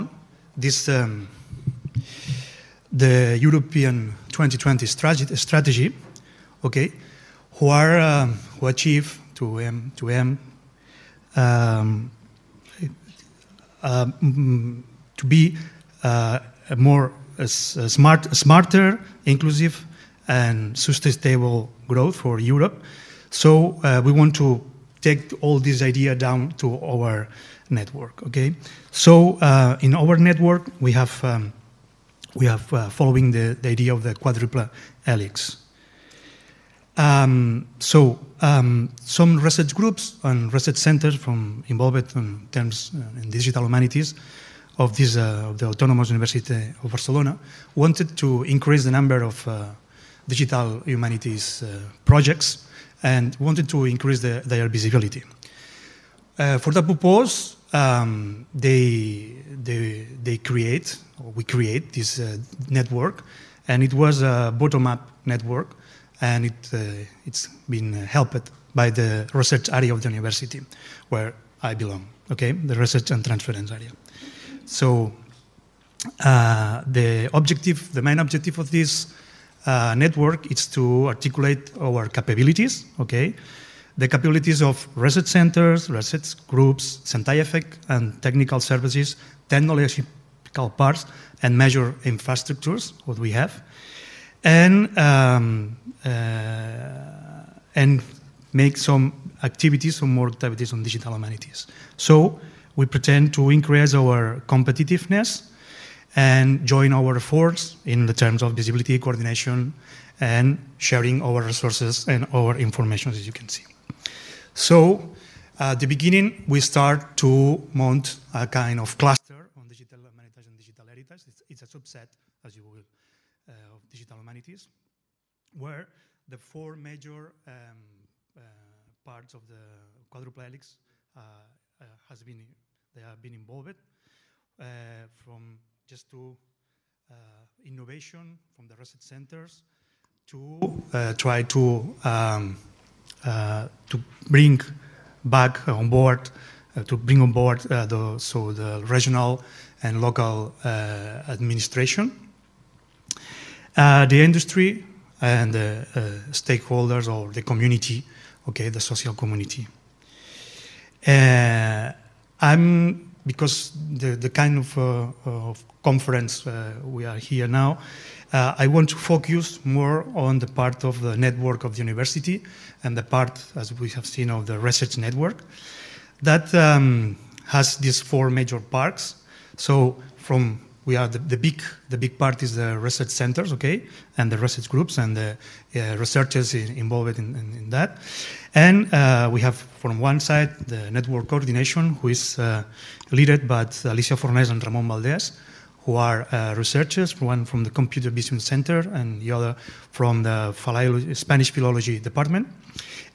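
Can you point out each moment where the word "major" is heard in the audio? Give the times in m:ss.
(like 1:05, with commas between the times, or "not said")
2:06, 2:58.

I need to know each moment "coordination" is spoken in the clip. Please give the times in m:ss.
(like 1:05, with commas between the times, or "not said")
1:48, 3:11.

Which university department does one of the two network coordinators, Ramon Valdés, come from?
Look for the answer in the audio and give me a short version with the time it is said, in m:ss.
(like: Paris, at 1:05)
Spanish philology department, at 3:21.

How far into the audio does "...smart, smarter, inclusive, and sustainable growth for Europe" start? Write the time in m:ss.
0:17.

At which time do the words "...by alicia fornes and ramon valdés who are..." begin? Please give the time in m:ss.
3:13.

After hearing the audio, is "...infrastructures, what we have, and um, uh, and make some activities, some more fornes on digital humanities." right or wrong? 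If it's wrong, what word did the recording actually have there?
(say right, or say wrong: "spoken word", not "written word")
wrong: "activities", not "fornes".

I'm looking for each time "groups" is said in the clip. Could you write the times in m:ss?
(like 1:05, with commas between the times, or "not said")
0:39, 1:26, 3:04.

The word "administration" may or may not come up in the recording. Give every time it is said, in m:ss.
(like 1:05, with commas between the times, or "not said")
2:31.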